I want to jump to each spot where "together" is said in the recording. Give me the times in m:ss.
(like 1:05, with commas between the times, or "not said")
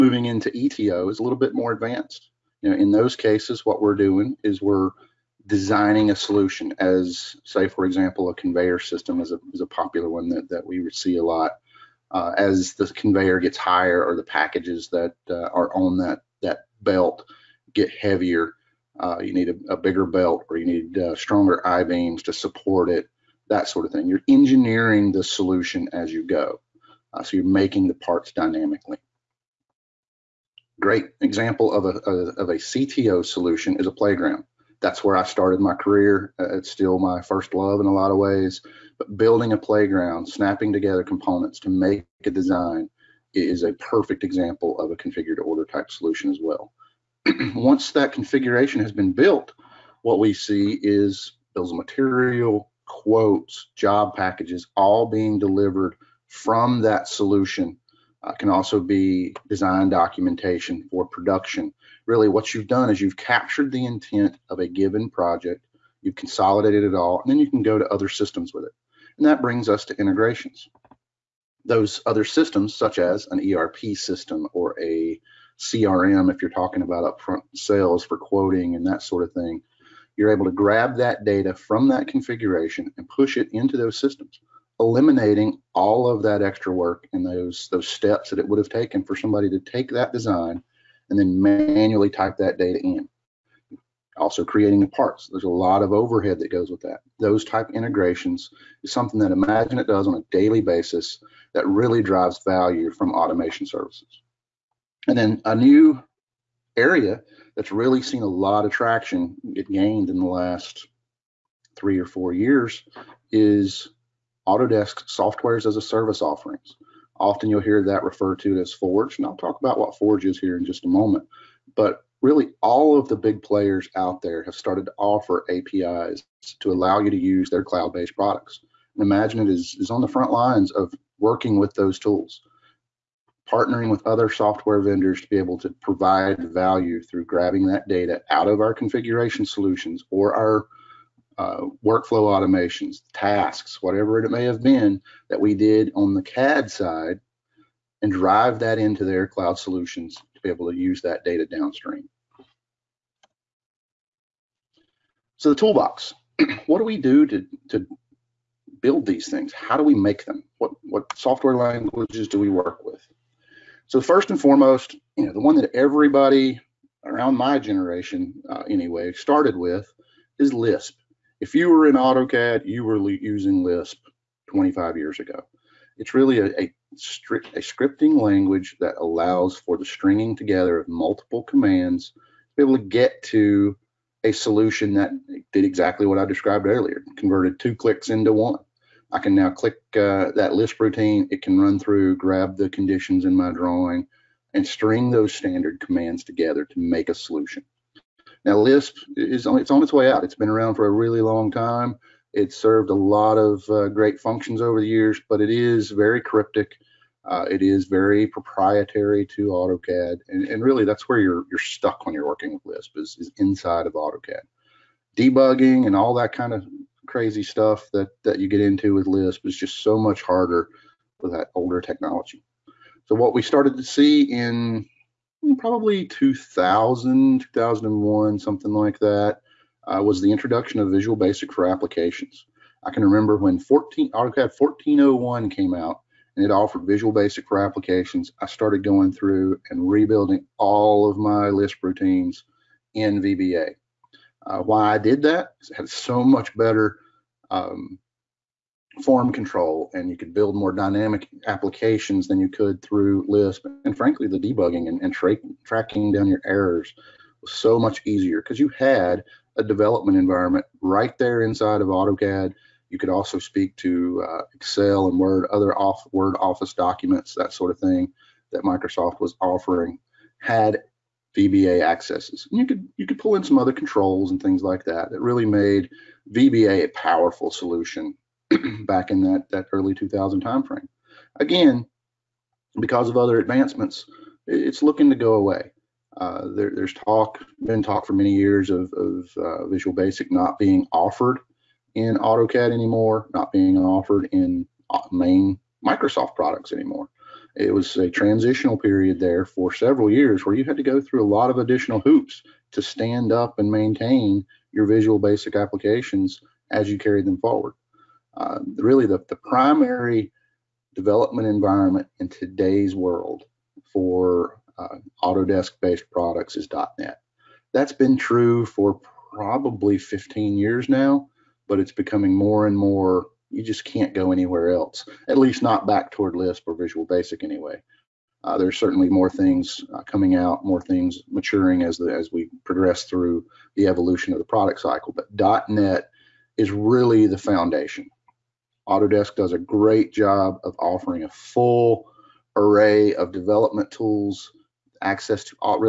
0:40, 3:00, 3:16.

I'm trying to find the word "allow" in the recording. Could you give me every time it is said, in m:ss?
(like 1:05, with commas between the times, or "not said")
2:06, 2:59.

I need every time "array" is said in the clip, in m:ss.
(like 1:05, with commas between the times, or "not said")
5:42.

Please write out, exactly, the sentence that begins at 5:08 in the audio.
Uh, really, the, the primary development environment in today's world for uh, Autodesk based products is .NET.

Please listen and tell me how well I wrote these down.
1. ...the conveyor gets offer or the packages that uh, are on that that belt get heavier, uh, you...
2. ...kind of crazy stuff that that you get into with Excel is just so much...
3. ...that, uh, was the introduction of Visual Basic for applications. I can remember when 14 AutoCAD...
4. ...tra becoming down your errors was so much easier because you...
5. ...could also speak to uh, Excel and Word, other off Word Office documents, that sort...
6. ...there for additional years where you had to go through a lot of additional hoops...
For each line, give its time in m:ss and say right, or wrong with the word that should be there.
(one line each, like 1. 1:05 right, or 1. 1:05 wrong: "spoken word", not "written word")
1. 0:12 wrong: "higher", not "offer"
2. 3:36 wrong: "Lisp", not "Excel"
3. 3:49 right
4. 4:15 wrong: "tracking", not "becoming"
5. 4:22 right
6. 4:59 wrong: "several", not "additional".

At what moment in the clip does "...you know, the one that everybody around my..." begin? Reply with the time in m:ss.
2:45.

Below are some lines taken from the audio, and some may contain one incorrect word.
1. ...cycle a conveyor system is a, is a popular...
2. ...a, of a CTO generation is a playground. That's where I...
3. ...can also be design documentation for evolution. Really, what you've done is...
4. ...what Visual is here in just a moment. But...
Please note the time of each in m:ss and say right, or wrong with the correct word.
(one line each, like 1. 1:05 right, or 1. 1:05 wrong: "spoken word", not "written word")
1. 0:07 wrong: "example", not "cycle"
2. 0:31 wrong: "solution", not "generation"
3. 0:58 wrong: "production", not "evolution"
4. 1:59 wrong: "Forge", not "Visual".